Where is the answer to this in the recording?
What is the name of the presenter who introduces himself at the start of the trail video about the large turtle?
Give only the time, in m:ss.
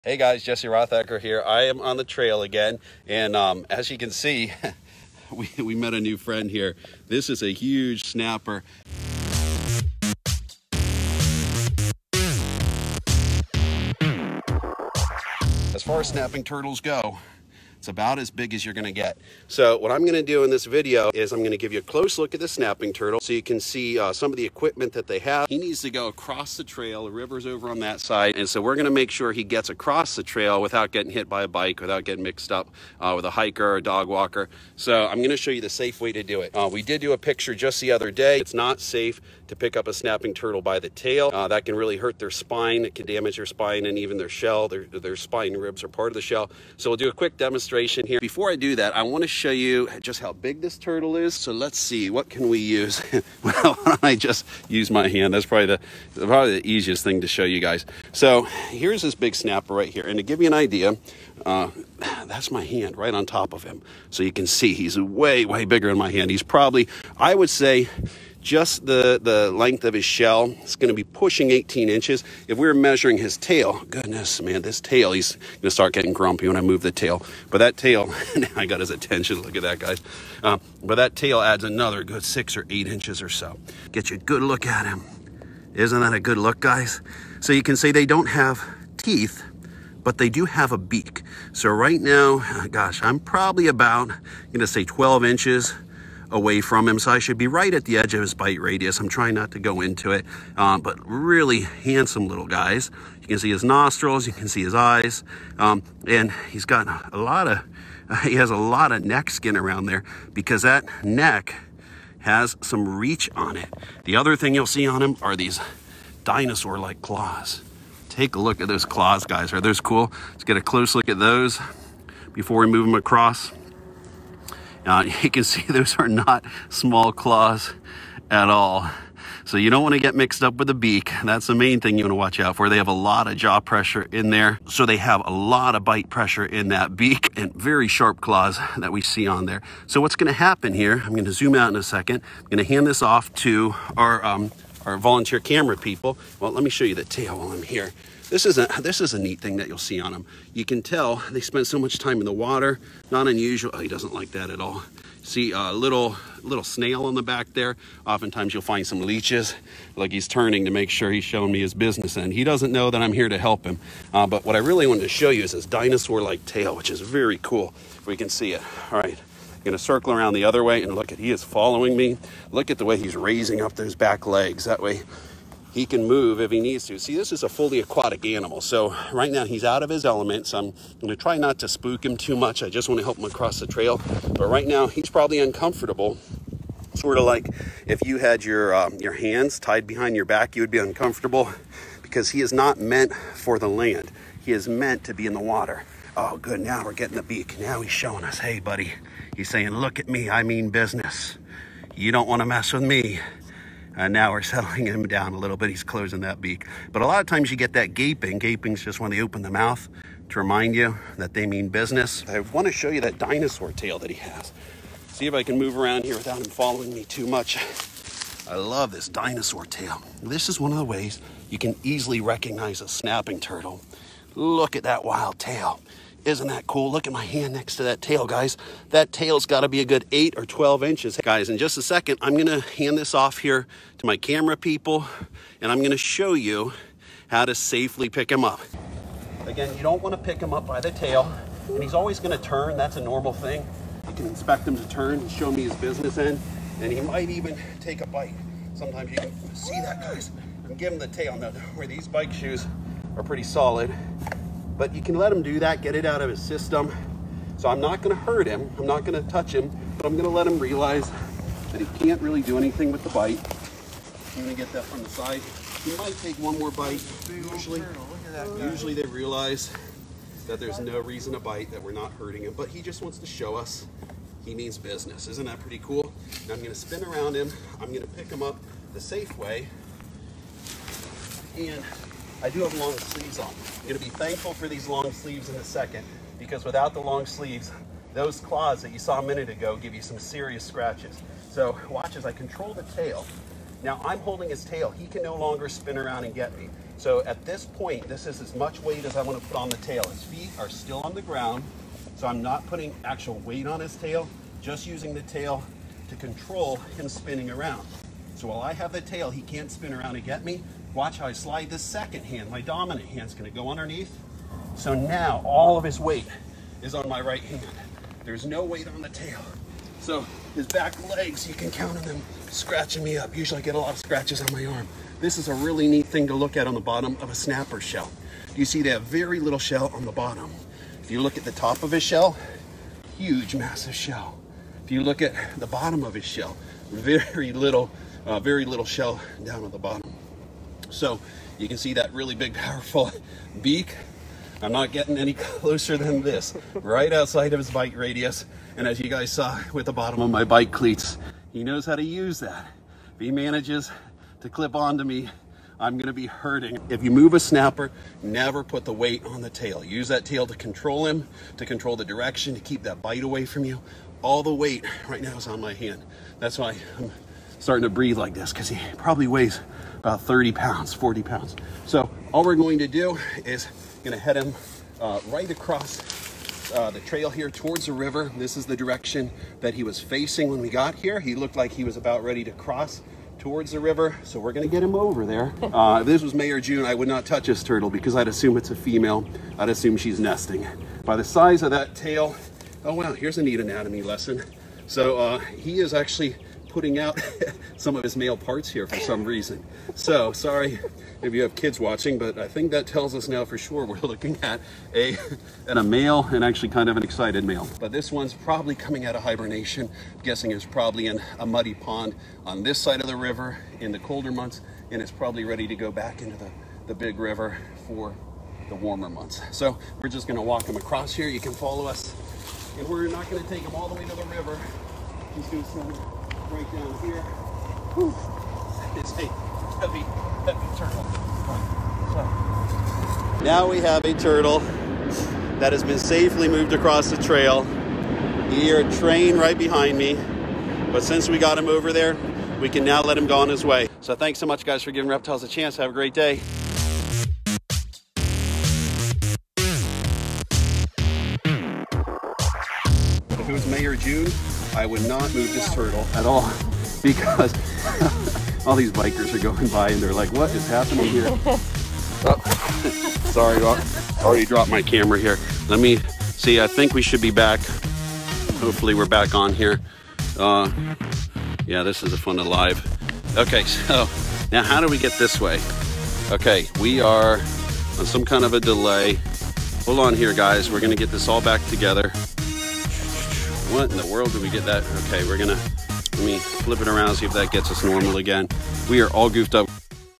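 0:00.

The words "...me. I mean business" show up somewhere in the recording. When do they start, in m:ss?
3:20.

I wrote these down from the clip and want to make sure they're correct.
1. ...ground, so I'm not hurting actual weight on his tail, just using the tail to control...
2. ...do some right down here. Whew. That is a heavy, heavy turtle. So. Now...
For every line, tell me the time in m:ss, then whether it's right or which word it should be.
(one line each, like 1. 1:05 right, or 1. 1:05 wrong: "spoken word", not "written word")
1. 5:01 wrong: "putting", not "hurting"
2. 7:05 right.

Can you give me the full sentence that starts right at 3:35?
See if I can move around here without him following me too much.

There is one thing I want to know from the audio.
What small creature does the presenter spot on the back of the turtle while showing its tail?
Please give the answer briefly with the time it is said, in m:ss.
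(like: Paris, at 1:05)
snail, at 2:36.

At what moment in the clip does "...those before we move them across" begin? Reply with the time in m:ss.
2:01.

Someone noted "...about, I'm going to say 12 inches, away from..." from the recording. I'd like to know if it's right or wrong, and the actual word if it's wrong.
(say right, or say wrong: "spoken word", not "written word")
right.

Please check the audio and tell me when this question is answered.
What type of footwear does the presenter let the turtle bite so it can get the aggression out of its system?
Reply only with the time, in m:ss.
4:12.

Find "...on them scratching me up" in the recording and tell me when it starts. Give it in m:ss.
5:21.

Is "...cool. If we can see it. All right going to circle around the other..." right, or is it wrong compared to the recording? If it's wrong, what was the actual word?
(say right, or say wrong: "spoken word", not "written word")
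right.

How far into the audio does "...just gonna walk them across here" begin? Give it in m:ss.
7:00.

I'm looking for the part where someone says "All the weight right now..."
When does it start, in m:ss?
6:04.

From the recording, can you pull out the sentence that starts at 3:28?
Gaping's just when they open the mouth to remind you that they mean business.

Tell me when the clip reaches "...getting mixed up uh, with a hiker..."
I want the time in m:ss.
0:32.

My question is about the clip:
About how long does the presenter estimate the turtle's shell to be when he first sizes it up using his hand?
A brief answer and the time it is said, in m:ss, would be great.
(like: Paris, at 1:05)
18 inches, at 1:11.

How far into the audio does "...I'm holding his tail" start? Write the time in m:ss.
4:54.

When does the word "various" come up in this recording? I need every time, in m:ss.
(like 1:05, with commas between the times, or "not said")
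not said.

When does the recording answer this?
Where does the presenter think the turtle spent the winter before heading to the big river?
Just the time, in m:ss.
6:51.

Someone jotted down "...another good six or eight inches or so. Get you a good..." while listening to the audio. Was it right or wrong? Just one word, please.
right.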